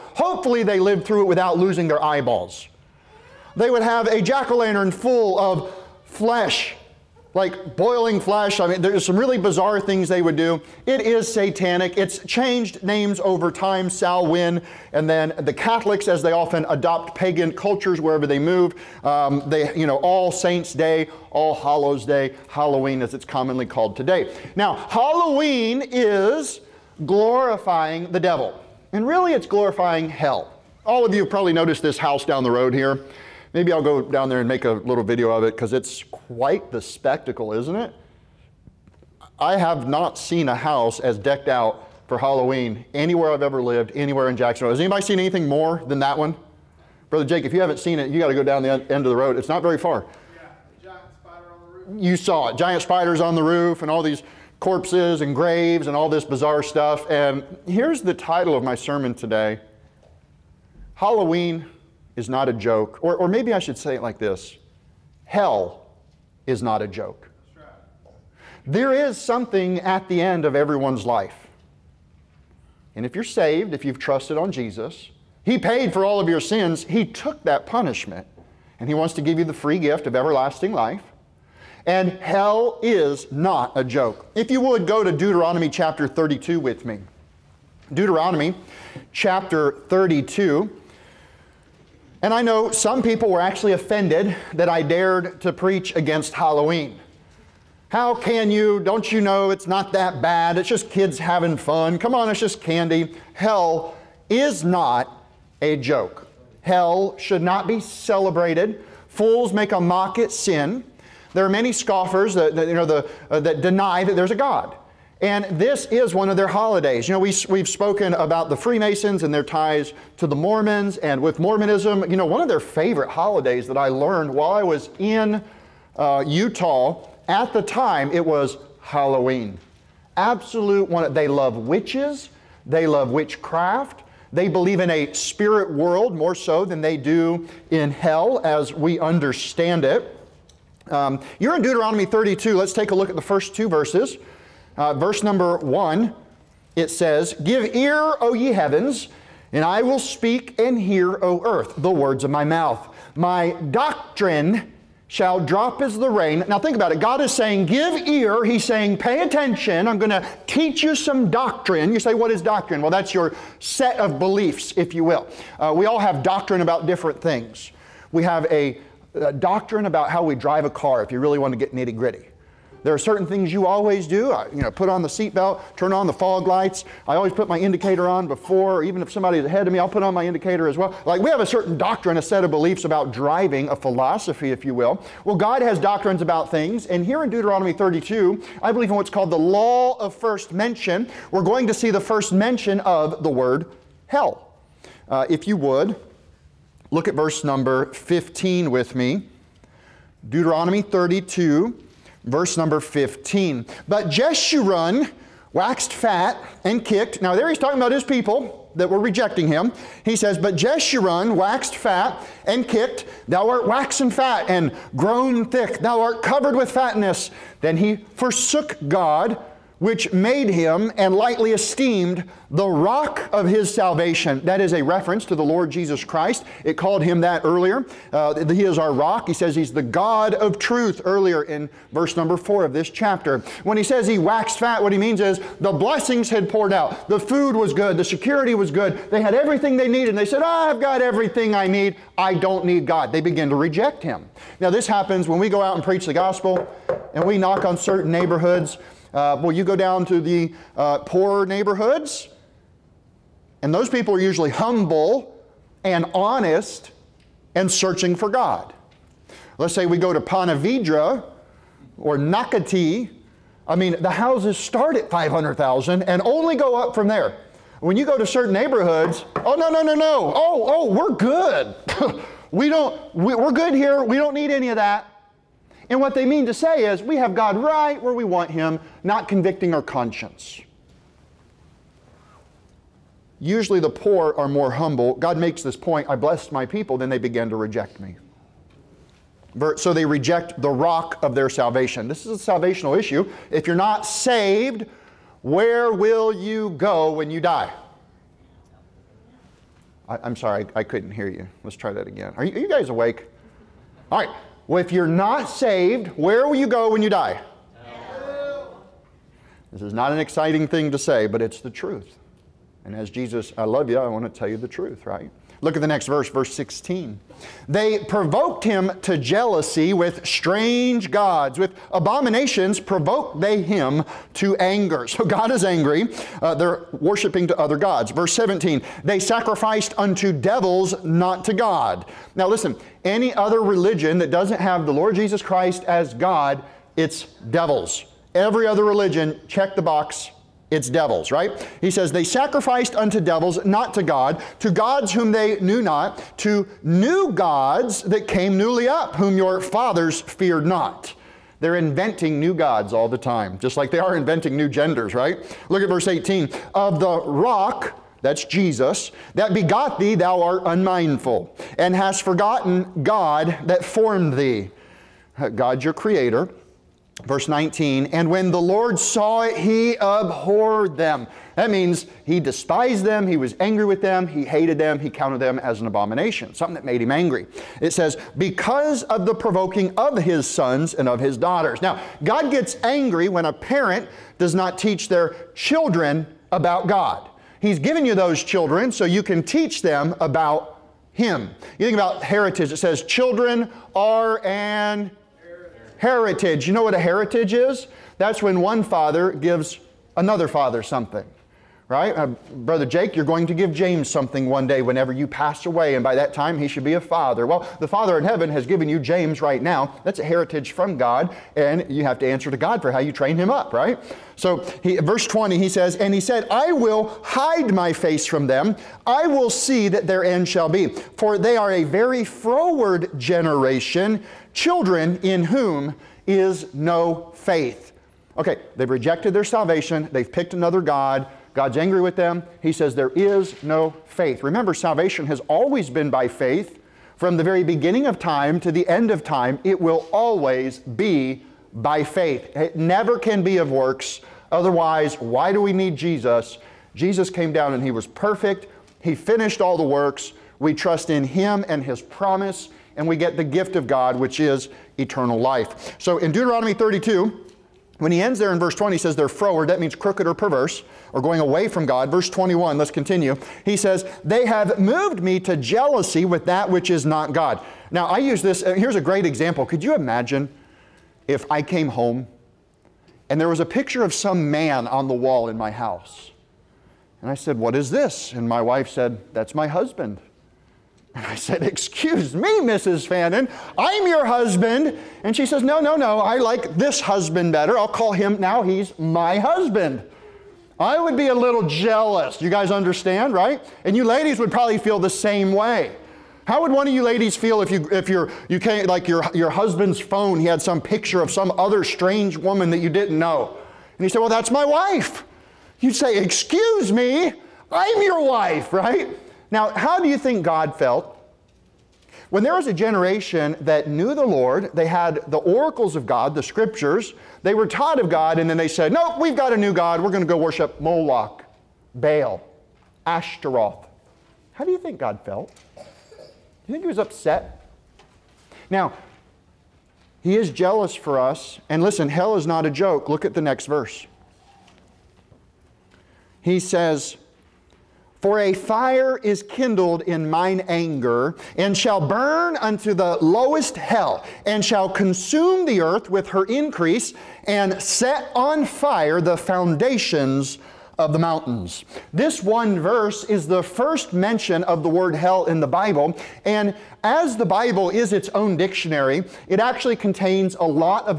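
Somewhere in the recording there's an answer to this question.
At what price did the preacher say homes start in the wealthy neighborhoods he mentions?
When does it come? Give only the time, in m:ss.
4:25.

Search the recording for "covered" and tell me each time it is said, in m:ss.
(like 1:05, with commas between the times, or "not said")
3:36.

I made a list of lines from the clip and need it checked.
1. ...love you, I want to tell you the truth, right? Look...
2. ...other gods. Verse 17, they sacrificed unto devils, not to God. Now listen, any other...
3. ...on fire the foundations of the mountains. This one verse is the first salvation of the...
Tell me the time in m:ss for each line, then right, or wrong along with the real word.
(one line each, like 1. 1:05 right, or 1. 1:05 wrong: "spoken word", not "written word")
1. 5:13 right
2. 5:27 right
3. 9:08 wrong: "mention", not "salvation".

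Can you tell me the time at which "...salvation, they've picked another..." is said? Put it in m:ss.
7:09.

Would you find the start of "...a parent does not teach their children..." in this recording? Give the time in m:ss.
6:23.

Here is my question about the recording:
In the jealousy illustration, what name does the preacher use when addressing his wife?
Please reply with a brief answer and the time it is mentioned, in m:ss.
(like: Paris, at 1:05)
Mrs. Fannin, at 8:02.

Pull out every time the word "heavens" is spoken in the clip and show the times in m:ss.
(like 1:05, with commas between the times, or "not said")
2:28, 6:48.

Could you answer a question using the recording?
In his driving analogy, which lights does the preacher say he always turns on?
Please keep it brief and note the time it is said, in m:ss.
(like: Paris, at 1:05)
Fog lights, at 2:56.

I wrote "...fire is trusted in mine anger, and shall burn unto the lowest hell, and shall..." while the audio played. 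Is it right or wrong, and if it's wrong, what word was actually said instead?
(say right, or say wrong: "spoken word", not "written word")
wrong: "kindled", not "trusted".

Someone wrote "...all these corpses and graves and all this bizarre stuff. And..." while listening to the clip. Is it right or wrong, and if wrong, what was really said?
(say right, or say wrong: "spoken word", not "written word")
right.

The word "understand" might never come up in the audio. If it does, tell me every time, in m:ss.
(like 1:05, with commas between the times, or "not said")
2:18, 8:12.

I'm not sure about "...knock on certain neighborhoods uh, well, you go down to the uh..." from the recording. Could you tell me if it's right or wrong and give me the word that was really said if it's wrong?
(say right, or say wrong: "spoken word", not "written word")
right.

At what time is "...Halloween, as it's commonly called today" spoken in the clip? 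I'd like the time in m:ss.
0:22.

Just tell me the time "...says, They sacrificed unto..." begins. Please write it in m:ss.
5:41.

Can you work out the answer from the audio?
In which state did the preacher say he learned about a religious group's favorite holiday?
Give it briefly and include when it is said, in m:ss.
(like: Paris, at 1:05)
Utah, at 2:06.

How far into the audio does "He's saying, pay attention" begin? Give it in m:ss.
2:38.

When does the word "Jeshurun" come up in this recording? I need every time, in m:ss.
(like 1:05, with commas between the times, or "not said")
3:24, 3:30.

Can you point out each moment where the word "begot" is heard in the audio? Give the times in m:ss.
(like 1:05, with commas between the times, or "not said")
5:59.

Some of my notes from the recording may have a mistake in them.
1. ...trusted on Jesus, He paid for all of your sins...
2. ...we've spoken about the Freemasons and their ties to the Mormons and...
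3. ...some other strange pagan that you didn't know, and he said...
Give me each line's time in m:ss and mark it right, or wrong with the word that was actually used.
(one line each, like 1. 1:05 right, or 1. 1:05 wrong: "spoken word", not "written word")
1. 1:13 right
2. 1:57 right
3. 8:21 wrong: "woman", not "pagan".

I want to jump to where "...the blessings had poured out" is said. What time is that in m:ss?
3:55.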